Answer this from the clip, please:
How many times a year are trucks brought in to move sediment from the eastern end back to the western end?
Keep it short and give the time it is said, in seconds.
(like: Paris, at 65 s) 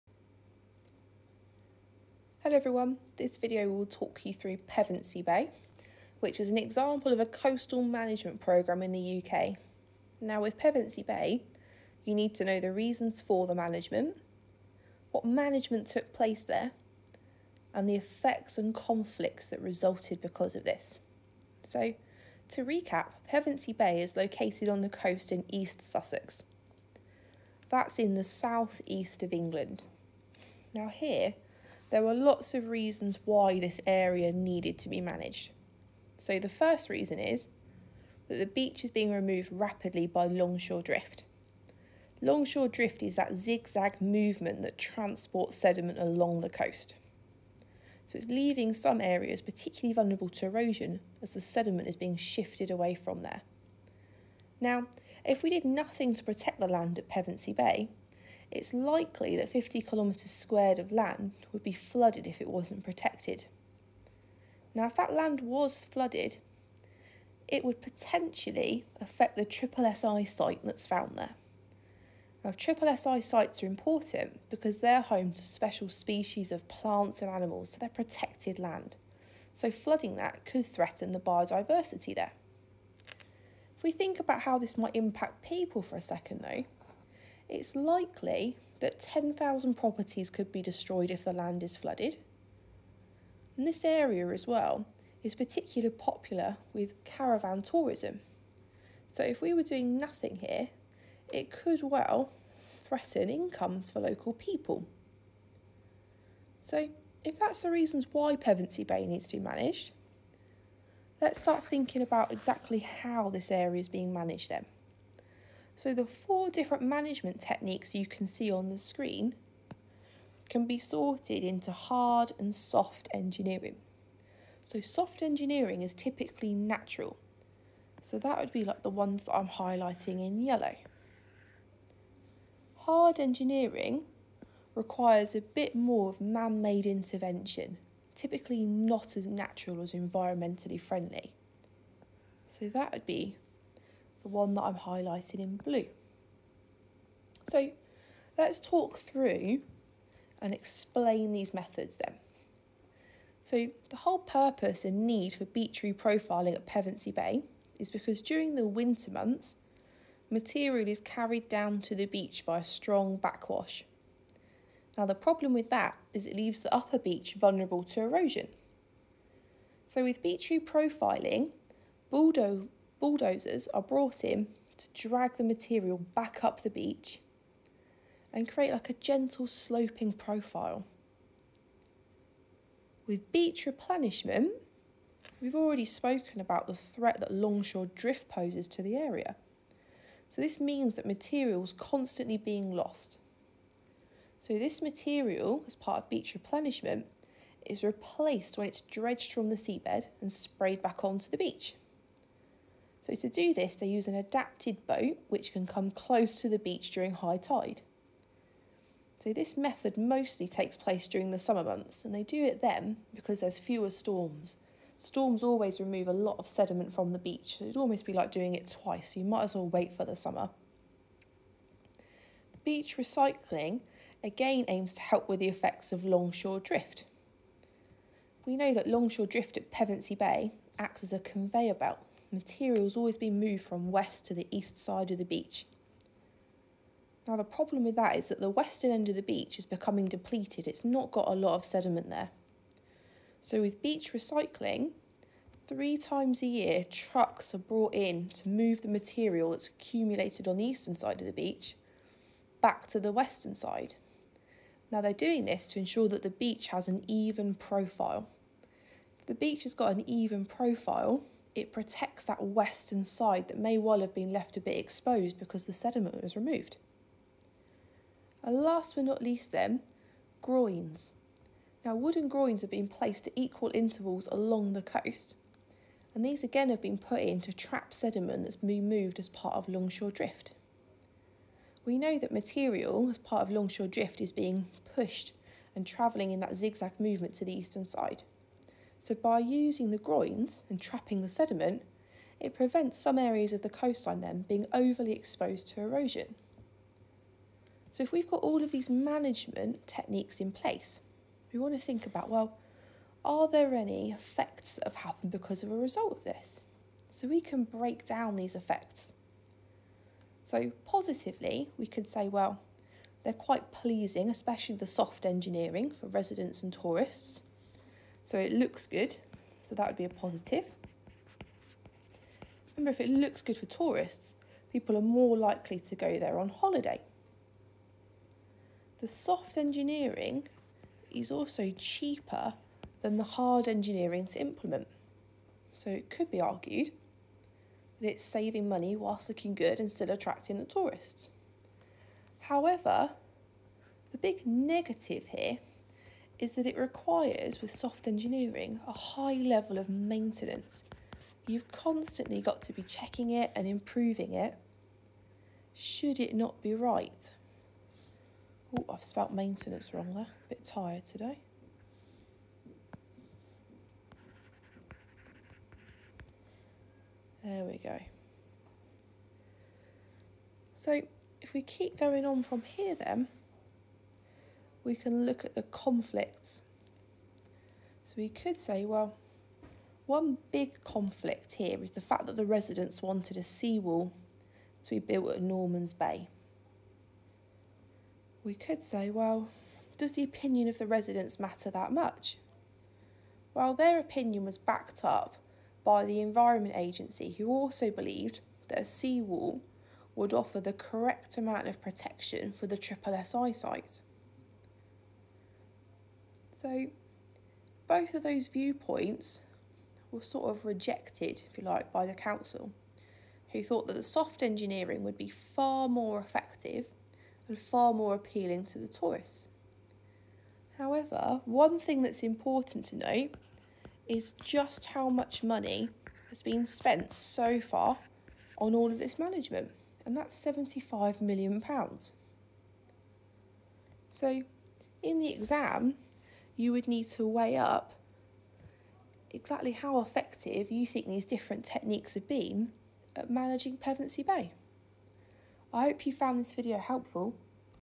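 3, at 245 s.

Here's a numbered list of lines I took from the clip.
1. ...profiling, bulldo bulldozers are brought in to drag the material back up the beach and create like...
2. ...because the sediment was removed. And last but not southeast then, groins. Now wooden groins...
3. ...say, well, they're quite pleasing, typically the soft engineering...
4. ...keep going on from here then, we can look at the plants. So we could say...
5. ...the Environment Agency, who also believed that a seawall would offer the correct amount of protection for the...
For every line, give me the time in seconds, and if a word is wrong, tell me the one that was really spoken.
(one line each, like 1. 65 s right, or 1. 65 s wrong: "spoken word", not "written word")
1. 170 s right
2. 265 s wrong: "least", not "southeast"
3. 312 s wrong: "especially", not "typically"
4. 371 s wrong: "conflicts", not "plants"
5. 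396 s right.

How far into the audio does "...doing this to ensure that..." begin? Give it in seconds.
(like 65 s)
255 s.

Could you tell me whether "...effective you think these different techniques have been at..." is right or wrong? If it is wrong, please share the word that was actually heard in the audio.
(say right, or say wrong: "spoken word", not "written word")
right.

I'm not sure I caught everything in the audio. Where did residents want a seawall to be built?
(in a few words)
Norman's Bay.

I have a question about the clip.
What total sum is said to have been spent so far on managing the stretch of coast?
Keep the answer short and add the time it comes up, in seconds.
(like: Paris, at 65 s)
£75 million, at 430 s.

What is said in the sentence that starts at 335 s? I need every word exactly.
So it could be argued that it's saving money whilst looking good and still attracting the tourists.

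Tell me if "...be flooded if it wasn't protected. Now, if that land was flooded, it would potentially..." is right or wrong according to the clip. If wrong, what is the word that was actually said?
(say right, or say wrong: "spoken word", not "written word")
right.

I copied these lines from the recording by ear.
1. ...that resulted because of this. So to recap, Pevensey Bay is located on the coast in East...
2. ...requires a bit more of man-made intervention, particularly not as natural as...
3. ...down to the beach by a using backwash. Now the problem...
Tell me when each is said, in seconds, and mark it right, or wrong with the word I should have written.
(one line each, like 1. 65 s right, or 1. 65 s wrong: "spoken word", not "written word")
1. 19 s right
2. 134 s wrong: "typically", not "particularly"
3. 161 s wrong: "strong", not "using".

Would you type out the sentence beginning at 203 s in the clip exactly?
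So to do this, they use an adapted boat which can come close to the beach during high tide.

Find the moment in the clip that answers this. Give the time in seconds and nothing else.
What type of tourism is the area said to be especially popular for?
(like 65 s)
97 s.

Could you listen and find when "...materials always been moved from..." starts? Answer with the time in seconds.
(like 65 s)
232 s.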